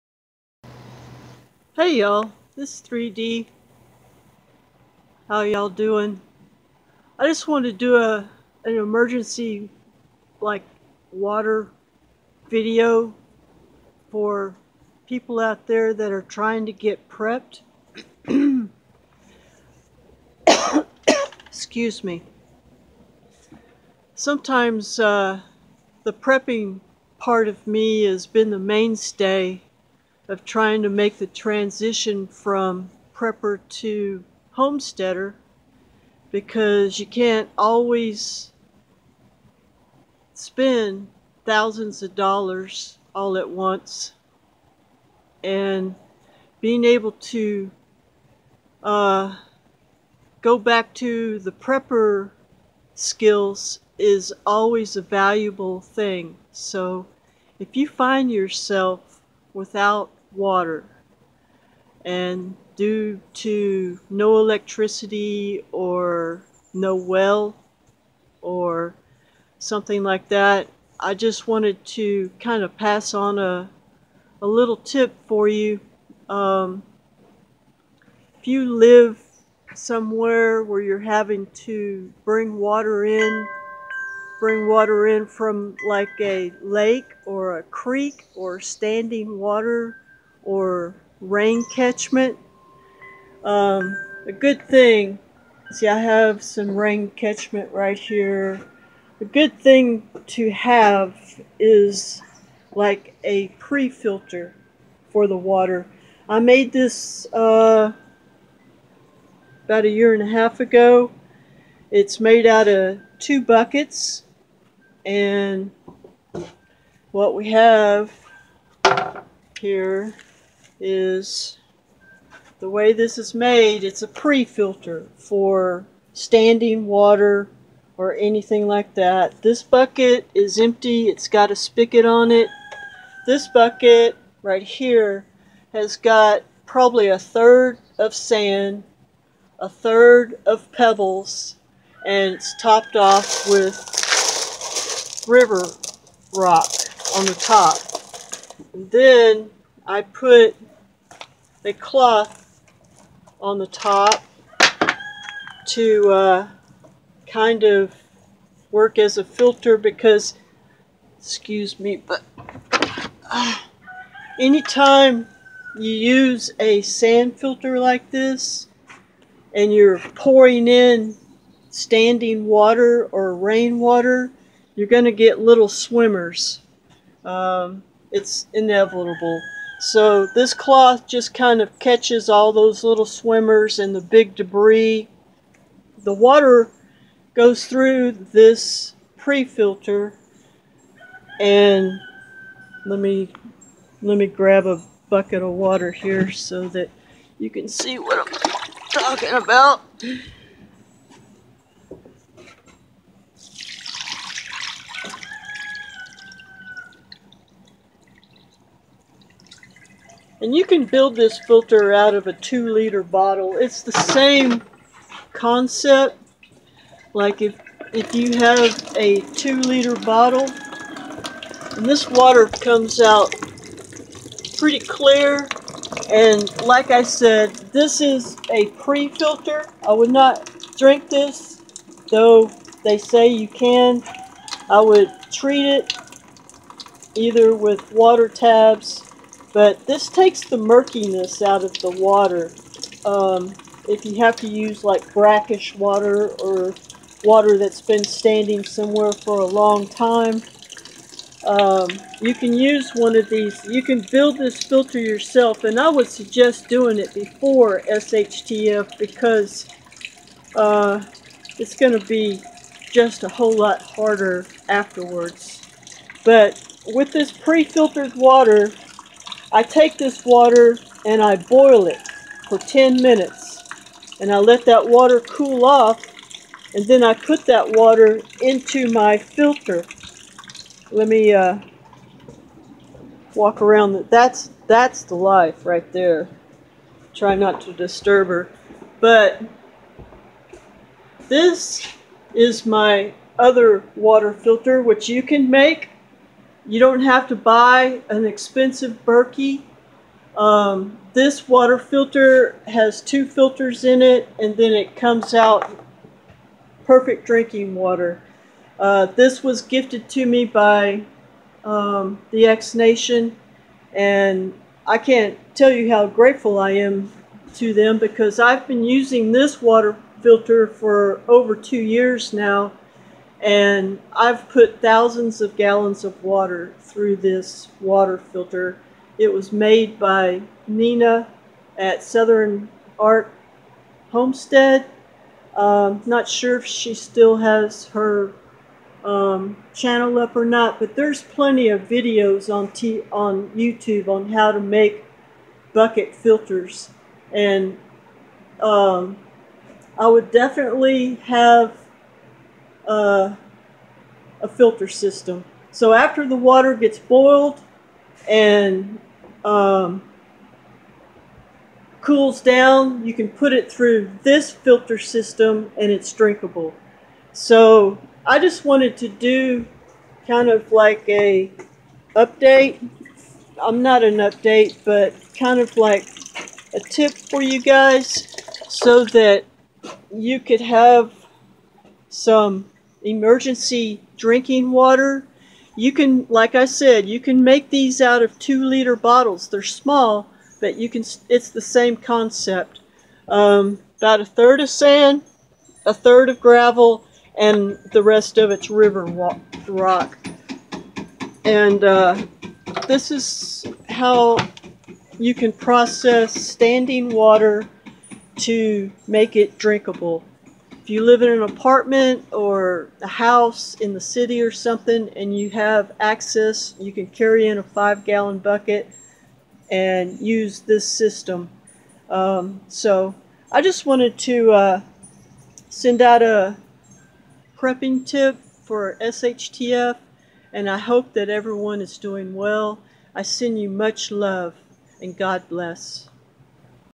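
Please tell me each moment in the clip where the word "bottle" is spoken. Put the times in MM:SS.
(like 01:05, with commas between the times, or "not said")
03:33, 03:39, 06:28.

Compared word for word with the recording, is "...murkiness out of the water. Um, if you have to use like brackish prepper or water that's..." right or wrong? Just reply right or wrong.
wrong.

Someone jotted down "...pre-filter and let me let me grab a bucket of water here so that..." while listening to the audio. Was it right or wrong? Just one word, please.
right.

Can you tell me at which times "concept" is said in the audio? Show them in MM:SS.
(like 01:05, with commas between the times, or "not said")
03:35, 06:31.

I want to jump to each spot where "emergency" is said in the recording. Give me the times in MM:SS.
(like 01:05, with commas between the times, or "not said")
00:08, 06:23.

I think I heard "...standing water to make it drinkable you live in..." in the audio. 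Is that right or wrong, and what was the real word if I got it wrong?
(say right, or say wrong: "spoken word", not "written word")
right.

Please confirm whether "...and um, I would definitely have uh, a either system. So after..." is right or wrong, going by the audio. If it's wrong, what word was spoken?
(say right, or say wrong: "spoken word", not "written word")
wrong: "filter", not "either".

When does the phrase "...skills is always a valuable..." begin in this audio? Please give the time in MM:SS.
00:52.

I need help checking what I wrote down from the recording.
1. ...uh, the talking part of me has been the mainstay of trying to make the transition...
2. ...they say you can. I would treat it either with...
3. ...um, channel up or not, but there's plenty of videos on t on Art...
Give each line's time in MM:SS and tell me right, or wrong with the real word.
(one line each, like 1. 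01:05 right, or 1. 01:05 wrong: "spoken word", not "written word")
1. 00:24 wrong: "prepping", not "talking"
2. 03:52 right
3. 05:39 wrong: "YouTube", not "Art".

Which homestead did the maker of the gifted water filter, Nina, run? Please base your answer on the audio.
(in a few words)
Southern Art Homestead.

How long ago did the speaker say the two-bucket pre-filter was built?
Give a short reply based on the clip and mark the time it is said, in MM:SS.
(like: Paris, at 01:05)
a year and a half, at 01:49.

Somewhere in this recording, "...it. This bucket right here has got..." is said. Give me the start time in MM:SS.
02:12.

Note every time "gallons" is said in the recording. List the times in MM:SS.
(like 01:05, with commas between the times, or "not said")
05:25, 06:58.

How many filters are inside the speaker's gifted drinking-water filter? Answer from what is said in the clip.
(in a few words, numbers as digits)
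2.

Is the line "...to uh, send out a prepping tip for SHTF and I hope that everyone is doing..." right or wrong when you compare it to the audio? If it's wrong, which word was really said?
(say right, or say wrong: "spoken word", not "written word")
right.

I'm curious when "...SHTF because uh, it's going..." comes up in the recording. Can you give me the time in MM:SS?
04:17.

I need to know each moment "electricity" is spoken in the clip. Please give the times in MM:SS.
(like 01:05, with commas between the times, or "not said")
01:04.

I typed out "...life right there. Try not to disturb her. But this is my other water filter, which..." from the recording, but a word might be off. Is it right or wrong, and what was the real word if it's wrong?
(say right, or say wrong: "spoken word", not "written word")
right.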